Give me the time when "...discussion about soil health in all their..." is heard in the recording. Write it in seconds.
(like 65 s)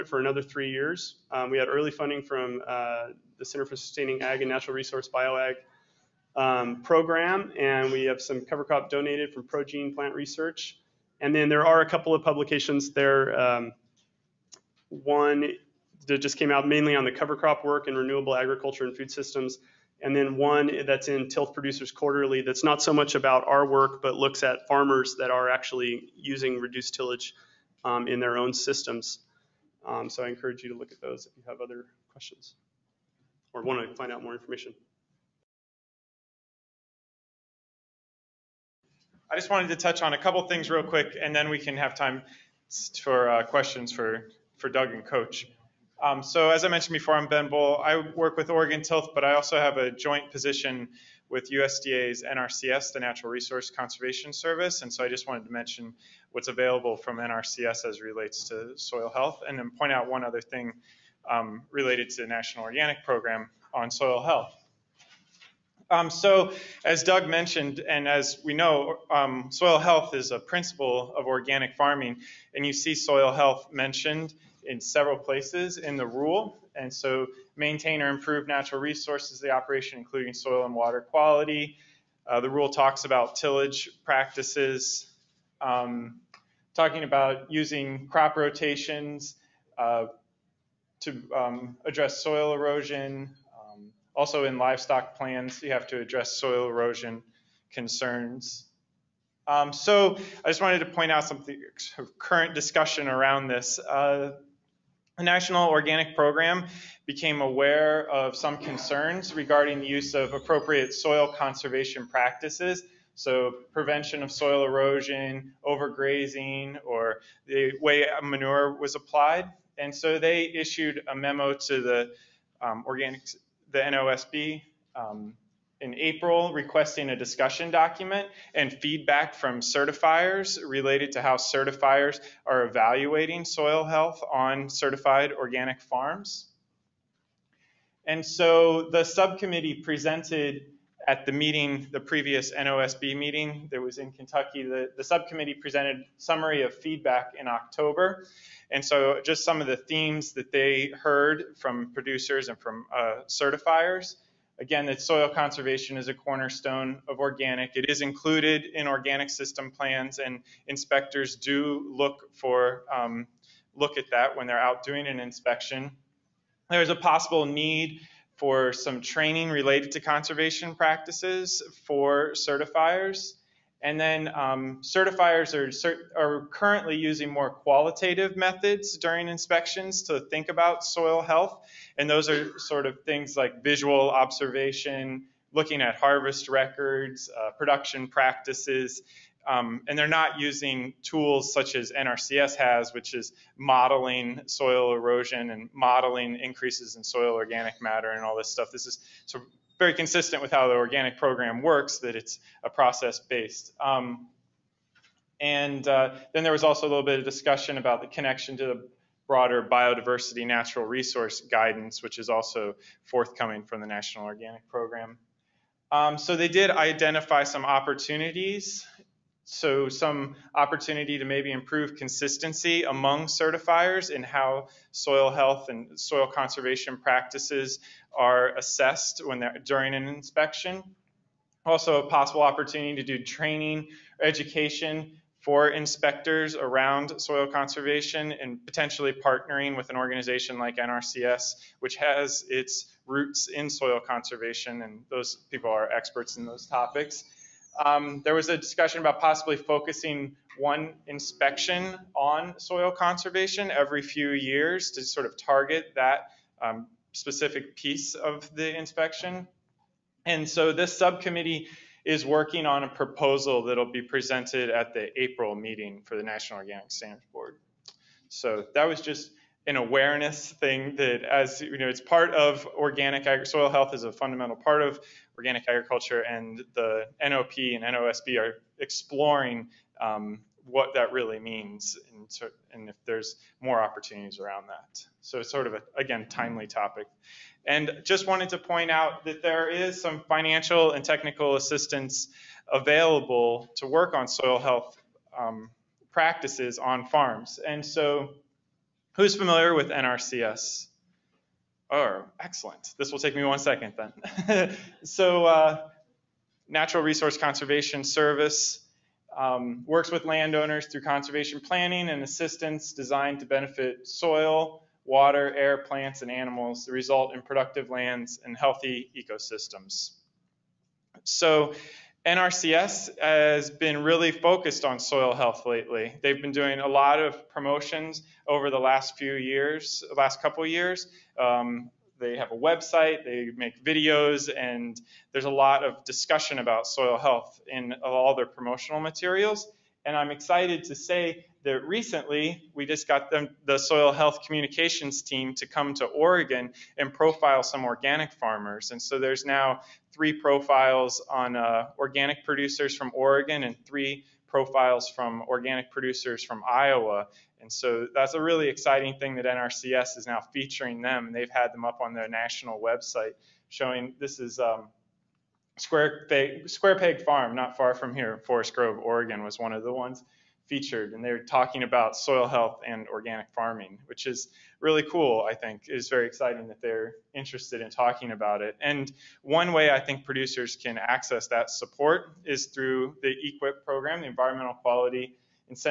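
336 s.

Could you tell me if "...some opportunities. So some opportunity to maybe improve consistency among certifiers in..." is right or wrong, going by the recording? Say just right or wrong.
right.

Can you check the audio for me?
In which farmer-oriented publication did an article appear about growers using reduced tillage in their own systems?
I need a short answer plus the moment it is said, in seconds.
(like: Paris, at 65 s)
Tilth Producers Quarterly, at 21 s.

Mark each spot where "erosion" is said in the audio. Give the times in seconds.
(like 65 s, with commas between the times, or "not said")
92 s, 96 s, 114 s, 194 s.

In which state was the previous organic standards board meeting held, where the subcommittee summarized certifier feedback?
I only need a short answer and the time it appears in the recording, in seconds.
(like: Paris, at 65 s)
Kentucky, at 144 s.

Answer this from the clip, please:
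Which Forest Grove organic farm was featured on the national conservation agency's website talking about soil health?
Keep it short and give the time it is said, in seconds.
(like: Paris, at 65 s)
Square Peg Farm, at 366 s.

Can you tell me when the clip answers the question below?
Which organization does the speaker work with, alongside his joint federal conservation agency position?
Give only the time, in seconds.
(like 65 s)
48 s.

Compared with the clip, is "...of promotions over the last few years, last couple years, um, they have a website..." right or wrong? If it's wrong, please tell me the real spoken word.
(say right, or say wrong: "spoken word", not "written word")
right.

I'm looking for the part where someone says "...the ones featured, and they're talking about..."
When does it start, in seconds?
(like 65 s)
369 s.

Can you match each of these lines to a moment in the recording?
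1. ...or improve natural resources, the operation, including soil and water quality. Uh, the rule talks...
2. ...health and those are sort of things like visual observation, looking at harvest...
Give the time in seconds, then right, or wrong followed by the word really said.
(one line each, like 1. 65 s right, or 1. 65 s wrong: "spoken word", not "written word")
1. 78 s right
2. 181 s right.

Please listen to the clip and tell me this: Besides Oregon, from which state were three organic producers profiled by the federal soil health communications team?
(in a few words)
Iowa.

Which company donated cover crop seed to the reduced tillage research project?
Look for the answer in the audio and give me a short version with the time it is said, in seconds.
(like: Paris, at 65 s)
ProGene Plant Research, at 9 s.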